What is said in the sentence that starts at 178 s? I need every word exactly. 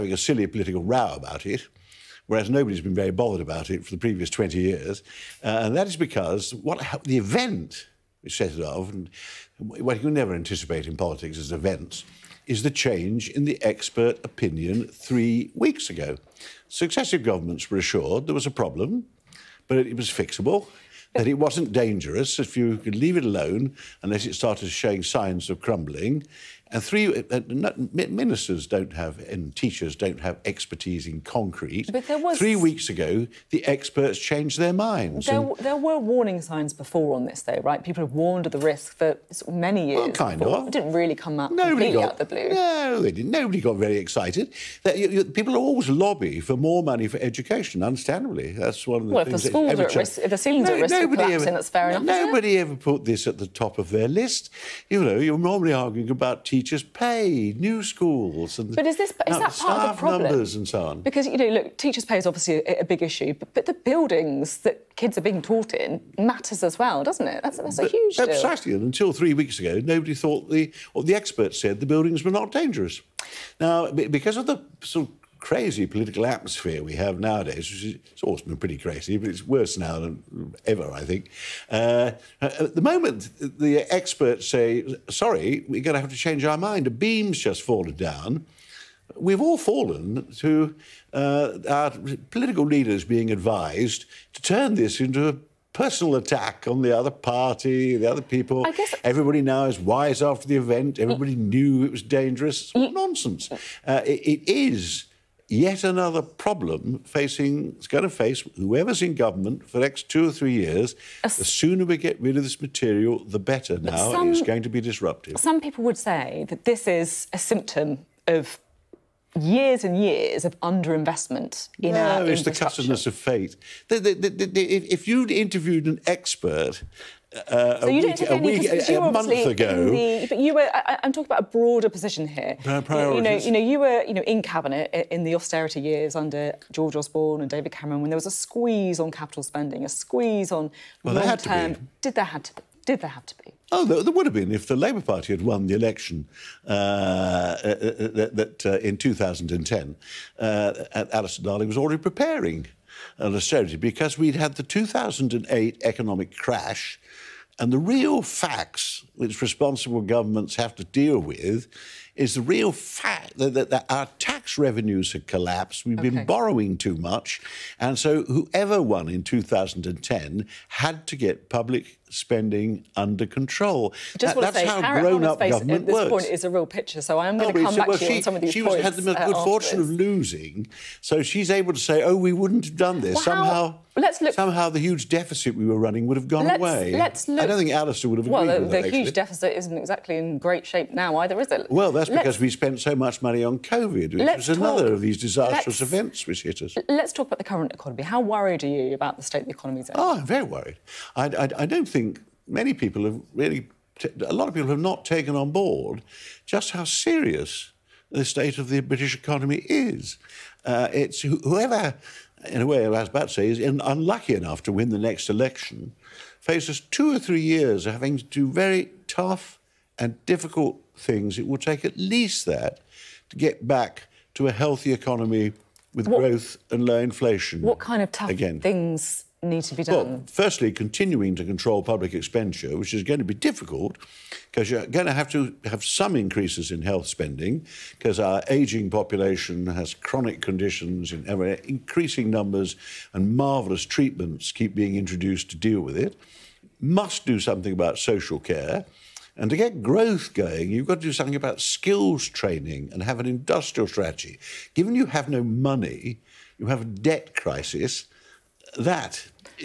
She had the uh, good fortune this.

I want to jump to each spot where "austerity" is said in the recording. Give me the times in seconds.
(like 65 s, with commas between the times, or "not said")
135 s, 153 s.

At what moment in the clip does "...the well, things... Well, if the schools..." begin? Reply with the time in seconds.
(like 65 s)
49 s.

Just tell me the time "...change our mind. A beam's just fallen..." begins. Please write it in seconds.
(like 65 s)
86 s.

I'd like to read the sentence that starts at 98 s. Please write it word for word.
I guess everybody now is wise after the event.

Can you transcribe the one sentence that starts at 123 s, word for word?
The, the, the, if you'd interviewed an expert uh, so a you week, don't take any you month ago.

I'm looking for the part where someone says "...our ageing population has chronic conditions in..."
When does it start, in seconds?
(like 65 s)
238 s.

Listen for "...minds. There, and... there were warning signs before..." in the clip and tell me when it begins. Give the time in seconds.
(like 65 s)
34 s.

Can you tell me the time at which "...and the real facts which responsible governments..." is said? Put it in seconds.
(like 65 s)
157 s.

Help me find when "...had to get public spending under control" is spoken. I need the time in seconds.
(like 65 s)
170 s.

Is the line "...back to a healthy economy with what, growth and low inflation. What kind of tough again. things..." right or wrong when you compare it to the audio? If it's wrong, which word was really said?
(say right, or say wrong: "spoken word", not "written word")
right.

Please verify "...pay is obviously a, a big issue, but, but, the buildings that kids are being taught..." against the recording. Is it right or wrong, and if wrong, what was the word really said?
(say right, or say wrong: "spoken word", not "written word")
right.